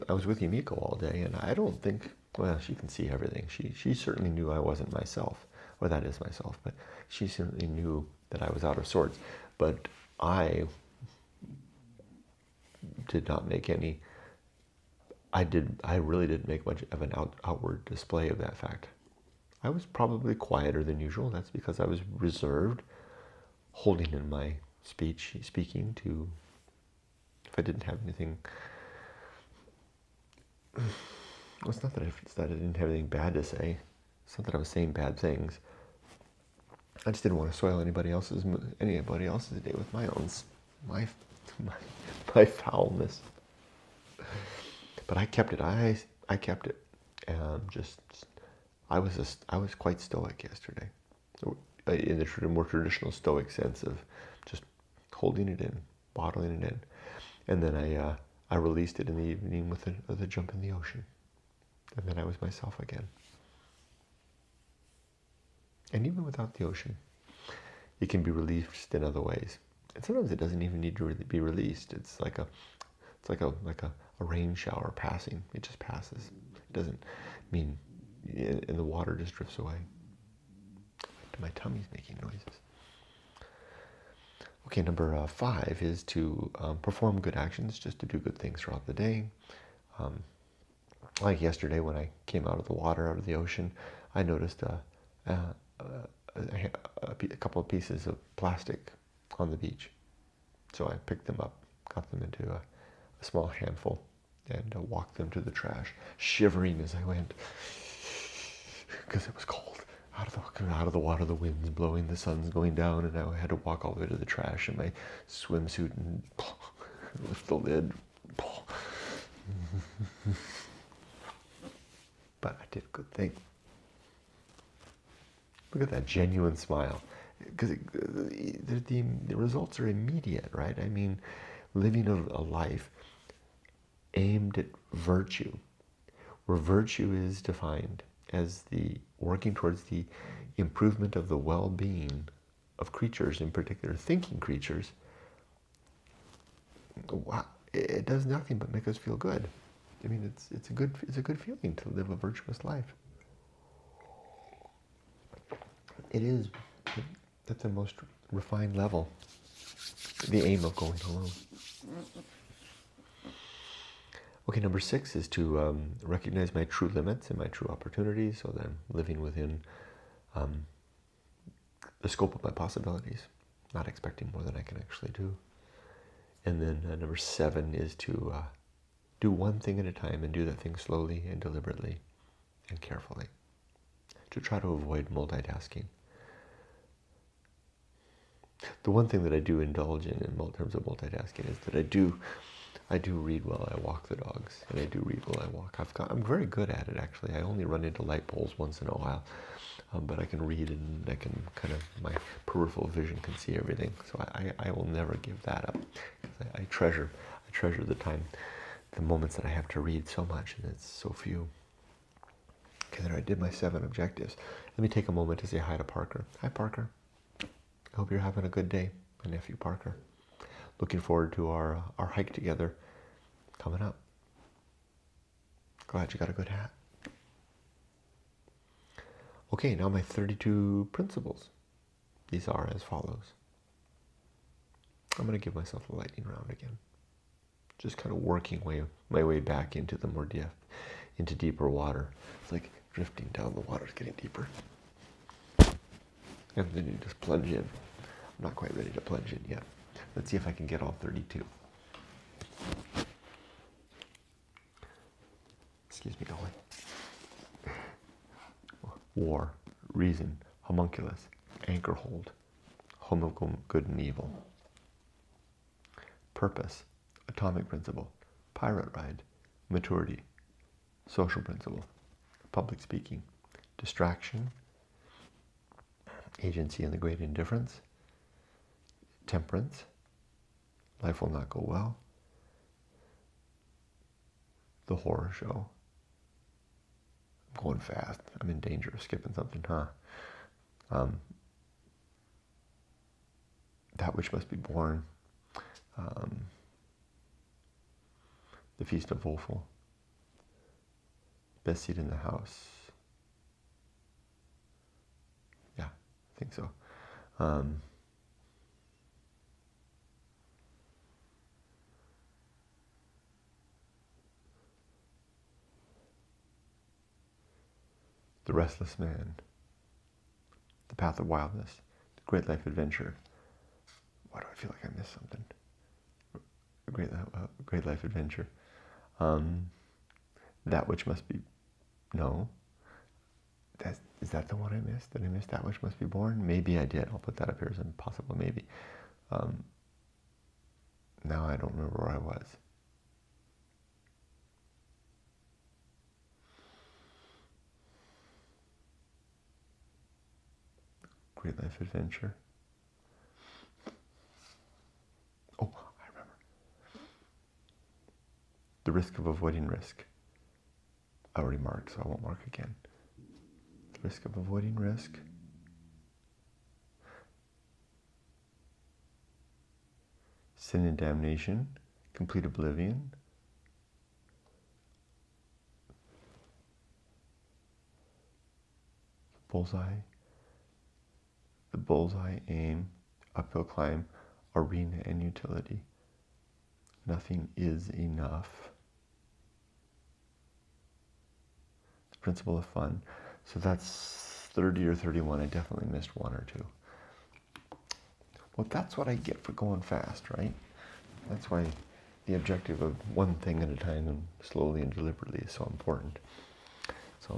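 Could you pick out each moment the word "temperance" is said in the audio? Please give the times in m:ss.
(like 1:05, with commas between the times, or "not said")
4:39.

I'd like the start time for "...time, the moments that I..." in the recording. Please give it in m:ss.
3:27.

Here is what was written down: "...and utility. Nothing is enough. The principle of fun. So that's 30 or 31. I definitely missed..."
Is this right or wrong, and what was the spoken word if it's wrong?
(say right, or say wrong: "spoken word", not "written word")
right.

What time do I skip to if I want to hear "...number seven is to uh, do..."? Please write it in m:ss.
2:56.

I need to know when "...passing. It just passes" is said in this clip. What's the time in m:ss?
1:14.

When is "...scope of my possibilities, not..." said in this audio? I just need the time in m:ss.
2:52.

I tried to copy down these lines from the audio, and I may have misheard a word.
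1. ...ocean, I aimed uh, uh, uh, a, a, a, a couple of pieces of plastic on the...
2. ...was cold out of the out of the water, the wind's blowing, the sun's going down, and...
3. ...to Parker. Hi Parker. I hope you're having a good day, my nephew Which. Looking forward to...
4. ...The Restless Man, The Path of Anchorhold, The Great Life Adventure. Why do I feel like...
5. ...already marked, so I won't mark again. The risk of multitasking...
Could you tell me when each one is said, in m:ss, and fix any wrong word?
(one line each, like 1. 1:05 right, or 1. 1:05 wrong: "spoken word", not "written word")
1. 1:33 wrong: "noticed", not "aimed"
2. 1:49 right
3. 3:35 wrong: "Parker", not "Which"
4. 5:18 wrong: "Wildness", not "Anchorhold"
5. 6:01 wrong: "avoiding", not "multitasking".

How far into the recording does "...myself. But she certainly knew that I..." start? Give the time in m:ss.
0:06.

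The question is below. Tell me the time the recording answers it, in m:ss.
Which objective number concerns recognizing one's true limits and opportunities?
2:44.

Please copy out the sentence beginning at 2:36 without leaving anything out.
It is at the most refined level the aim of going alone.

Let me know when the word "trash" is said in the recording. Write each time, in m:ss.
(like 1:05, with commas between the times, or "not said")
1:45, 1:54.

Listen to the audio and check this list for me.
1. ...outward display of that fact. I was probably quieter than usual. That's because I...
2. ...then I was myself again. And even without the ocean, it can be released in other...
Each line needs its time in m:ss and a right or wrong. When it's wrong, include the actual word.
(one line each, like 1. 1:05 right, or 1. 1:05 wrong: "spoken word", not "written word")
1. 0:17 right
2. 1:02 right.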